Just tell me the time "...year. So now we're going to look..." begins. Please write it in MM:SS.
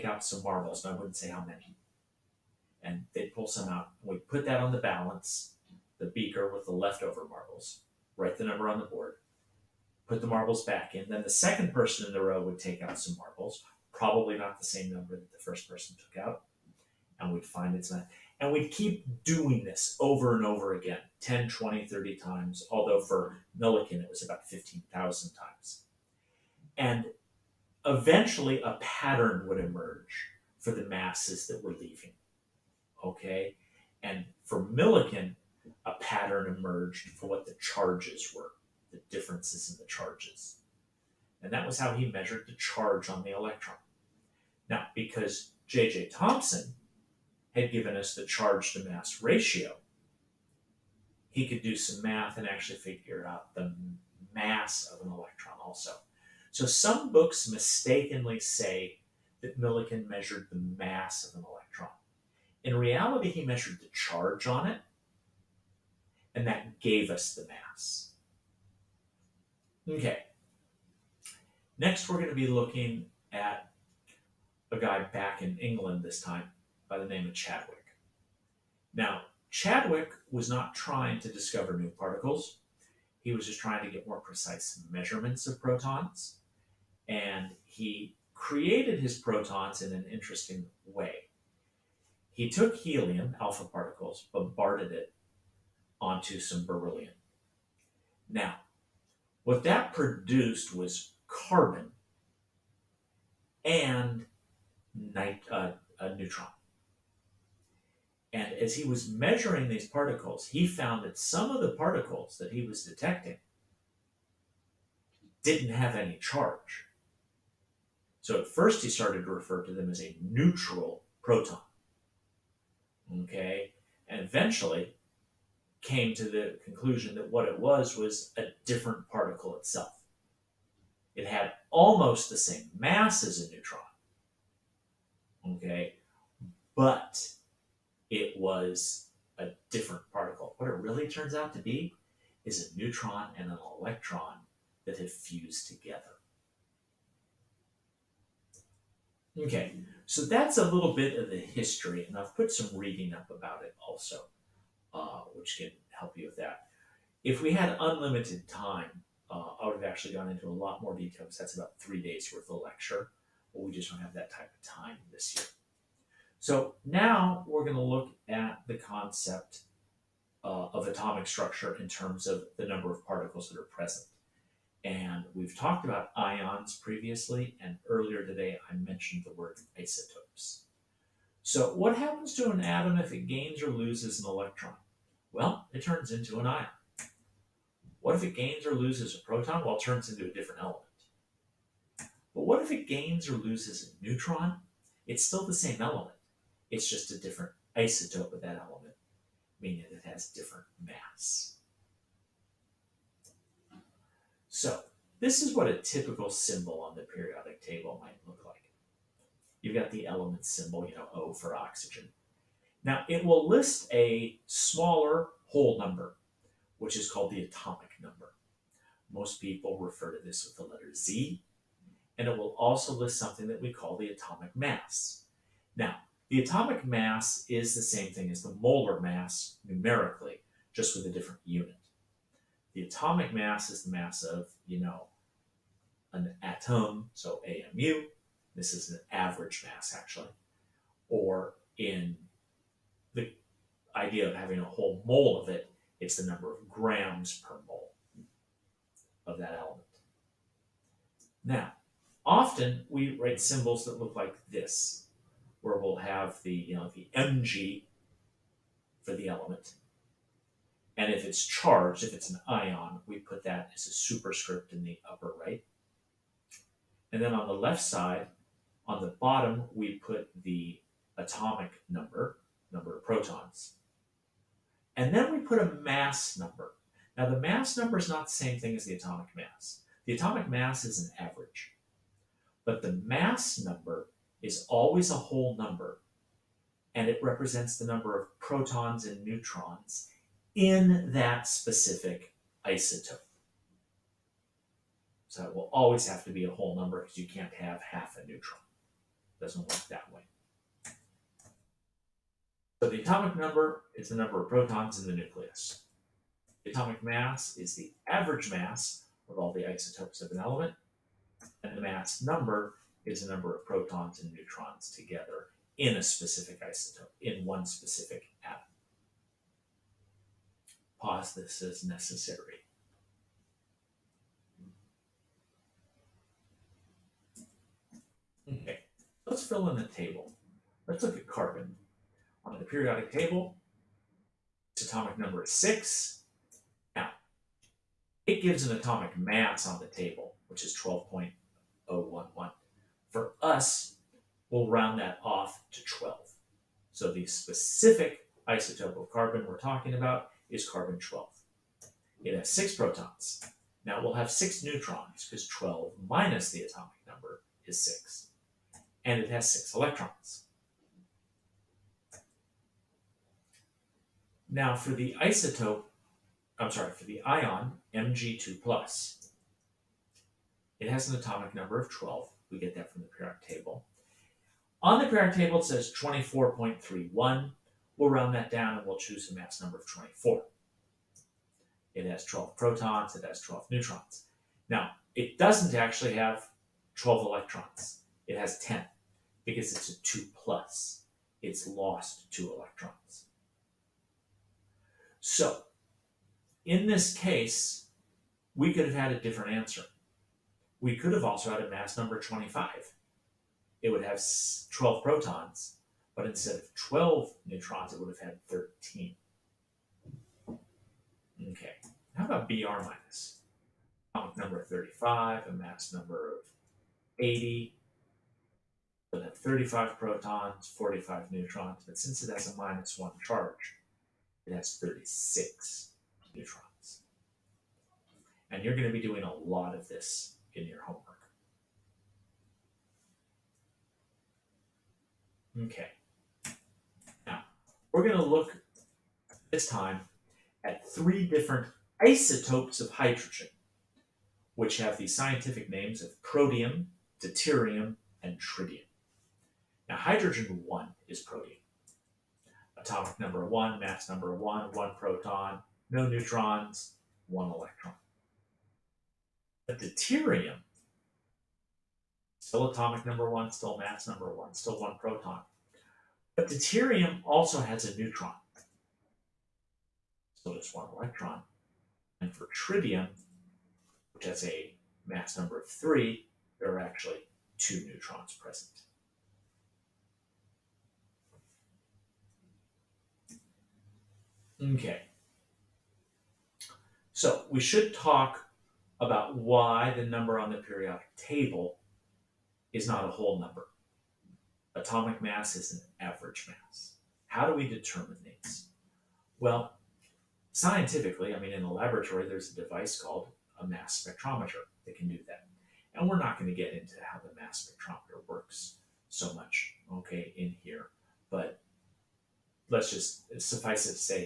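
02:45.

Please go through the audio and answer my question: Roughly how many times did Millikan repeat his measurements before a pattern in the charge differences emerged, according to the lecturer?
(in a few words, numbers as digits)
15,000.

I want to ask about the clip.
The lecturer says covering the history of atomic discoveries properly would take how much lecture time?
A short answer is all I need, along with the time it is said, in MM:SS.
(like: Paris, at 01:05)
three days, at 02:41.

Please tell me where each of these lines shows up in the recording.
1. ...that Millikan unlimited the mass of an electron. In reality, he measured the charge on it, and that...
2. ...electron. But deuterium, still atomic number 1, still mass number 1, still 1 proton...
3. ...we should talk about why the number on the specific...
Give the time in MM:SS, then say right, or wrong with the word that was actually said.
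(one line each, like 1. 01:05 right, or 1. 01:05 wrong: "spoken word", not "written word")
1. 00:59 wrong: "measured", not "unlimited"
2. 07:37 right
3. 08:07 wrong: "periodic", not "specific".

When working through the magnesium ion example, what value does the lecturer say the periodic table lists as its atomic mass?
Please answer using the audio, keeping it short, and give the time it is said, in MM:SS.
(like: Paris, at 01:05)
24.31, at 06:15.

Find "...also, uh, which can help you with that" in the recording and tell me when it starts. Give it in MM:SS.
02:33.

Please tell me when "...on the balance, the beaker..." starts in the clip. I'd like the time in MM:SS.
00:04.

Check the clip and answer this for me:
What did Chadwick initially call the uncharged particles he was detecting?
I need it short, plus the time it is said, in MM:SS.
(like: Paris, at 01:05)
neutral proton, at 02:00.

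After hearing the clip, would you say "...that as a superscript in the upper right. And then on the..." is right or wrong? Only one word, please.
right.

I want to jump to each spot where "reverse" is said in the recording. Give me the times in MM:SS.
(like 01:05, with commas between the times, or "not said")
not said.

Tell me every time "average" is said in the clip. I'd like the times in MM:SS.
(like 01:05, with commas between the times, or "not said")
03:59, 04:41, 05:08, 08:16.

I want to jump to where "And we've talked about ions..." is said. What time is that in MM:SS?
02:54.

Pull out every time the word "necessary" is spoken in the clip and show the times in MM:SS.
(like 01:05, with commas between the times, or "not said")
05:21.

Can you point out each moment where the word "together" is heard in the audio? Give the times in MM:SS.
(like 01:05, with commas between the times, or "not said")
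02:25, 05:14.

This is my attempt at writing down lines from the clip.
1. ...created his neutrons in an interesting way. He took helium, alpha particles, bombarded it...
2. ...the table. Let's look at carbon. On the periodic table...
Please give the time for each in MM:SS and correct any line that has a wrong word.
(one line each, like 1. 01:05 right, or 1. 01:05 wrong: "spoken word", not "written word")
1. 01:28 wrong: "protons", not "neutrons"
2. 05:29 right.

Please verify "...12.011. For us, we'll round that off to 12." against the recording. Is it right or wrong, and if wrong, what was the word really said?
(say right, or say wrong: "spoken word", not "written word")
right.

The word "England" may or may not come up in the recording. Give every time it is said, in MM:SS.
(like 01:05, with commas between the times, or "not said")
01:15.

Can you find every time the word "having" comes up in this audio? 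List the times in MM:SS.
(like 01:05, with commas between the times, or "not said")
04:04.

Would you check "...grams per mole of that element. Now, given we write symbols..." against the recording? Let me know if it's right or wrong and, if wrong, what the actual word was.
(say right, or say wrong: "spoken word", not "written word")
wrong: "often", not "given".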